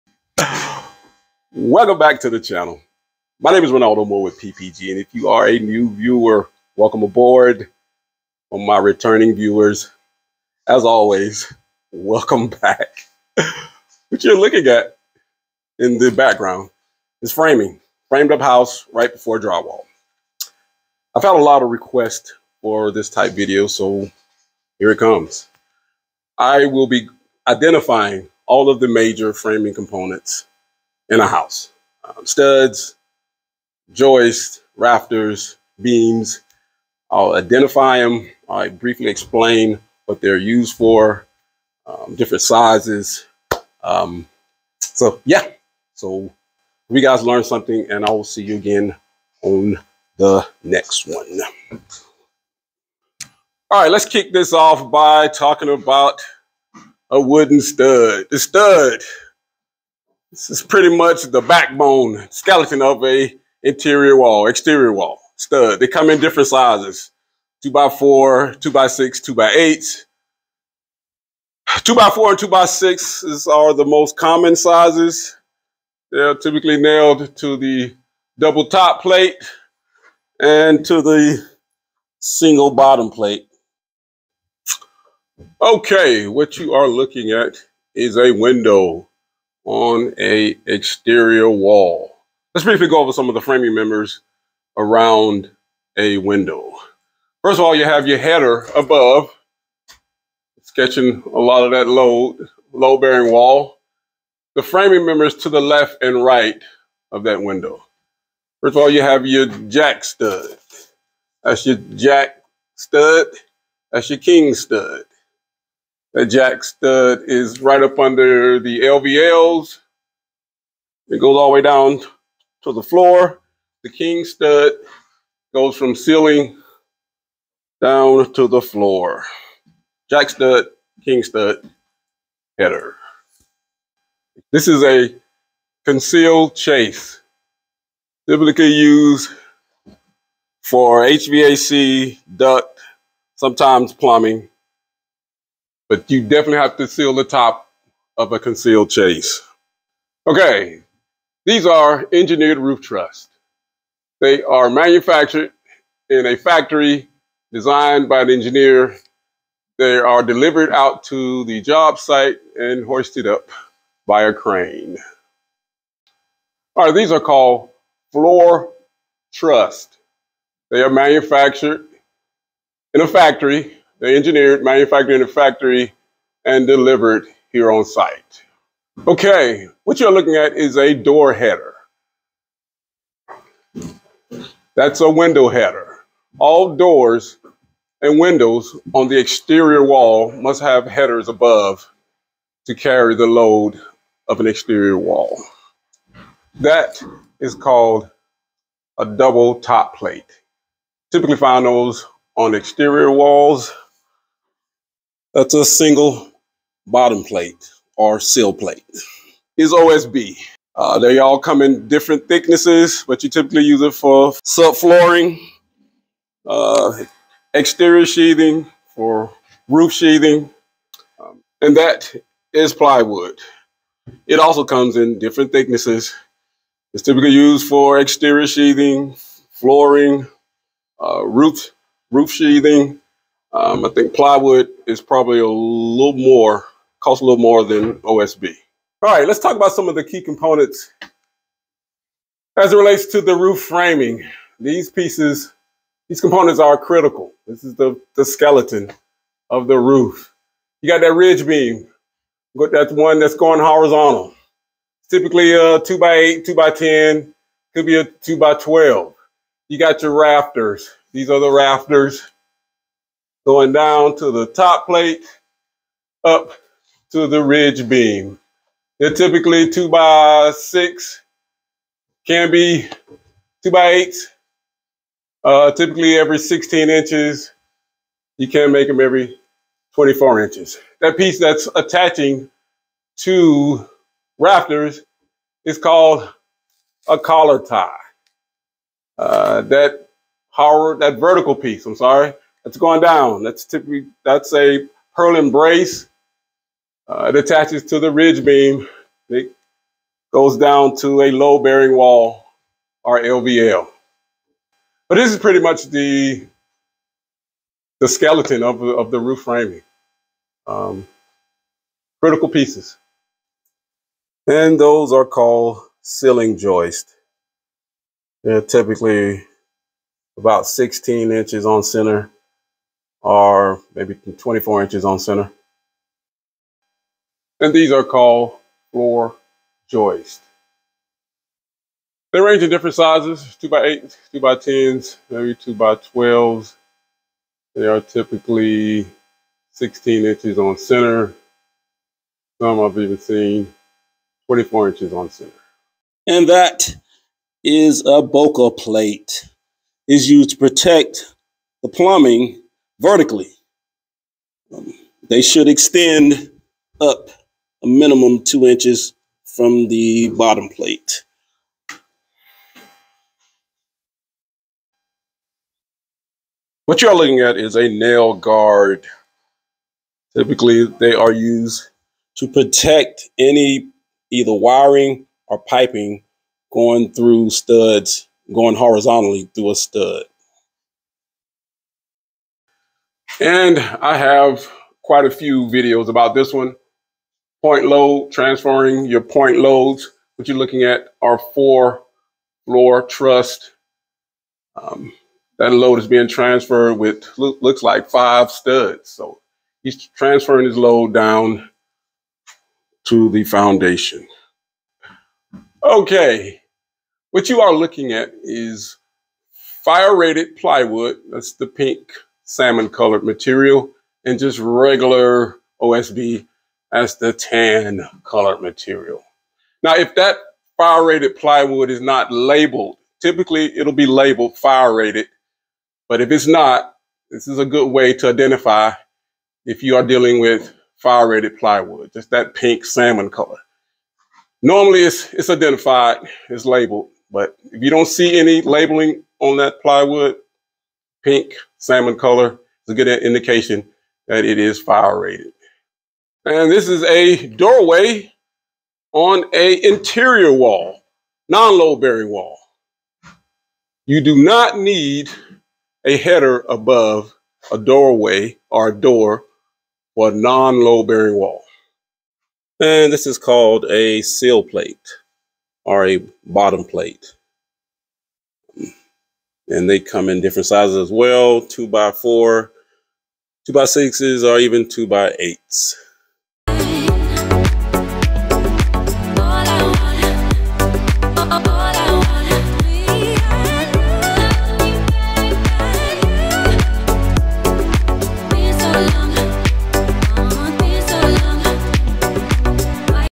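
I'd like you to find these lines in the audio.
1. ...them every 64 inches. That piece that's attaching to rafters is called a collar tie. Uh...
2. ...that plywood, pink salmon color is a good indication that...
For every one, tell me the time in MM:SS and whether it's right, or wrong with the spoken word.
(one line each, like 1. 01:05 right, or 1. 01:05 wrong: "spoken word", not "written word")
1. 04:38 wrong: "24", not "64"
2. 07:19 right.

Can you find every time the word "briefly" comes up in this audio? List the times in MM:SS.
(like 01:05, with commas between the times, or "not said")
00:38, 01:32.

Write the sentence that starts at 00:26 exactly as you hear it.
I will be identifying all of the major framing components in a house.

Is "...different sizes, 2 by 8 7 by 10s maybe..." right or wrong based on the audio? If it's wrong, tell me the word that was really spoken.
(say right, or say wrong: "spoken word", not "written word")
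wrong: "2", not "7".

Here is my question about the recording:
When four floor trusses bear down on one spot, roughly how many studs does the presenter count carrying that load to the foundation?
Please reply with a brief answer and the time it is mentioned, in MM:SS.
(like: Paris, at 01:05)
5, at 06:38.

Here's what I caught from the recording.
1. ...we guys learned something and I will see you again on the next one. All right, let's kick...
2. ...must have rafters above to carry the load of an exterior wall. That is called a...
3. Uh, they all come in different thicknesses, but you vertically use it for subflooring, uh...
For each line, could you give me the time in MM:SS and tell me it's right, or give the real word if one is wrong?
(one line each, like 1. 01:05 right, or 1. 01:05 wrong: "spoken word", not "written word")
1. 00:46 right
2. 03:10 wrong: "headers", not "rafters"
3. 03:30 wrong: "typically", not "vertically".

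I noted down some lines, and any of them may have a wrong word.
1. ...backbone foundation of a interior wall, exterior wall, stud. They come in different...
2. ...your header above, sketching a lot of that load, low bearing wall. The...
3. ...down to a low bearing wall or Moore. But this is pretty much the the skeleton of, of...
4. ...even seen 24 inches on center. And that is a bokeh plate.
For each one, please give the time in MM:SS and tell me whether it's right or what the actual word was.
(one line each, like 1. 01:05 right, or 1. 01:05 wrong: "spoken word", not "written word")
1. 01:01 wrong: "skeleton", not "foundation"
2. 01:38 right
3. 05:00 wrong: "LVL", not "Moore"
4. 05:42 right.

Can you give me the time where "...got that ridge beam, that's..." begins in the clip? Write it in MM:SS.
04:10.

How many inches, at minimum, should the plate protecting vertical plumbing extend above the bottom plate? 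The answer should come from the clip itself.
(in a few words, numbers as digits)
2 inches.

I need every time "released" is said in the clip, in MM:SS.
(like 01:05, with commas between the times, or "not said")
not said.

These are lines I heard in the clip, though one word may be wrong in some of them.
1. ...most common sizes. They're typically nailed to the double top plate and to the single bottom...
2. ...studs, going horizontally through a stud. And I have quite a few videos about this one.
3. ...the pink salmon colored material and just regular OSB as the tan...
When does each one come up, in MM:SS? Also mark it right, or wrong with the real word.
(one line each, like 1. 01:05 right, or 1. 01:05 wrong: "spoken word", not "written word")
1. 01:13 right
2. 06:17 right
3. 06:51 right.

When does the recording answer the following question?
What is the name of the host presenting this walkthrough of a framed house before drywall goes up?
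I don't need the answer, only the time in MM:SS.
00:03.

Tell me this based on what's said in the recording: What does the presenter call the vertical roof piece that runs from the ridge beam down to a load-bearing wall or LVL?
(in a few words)
purlin brace.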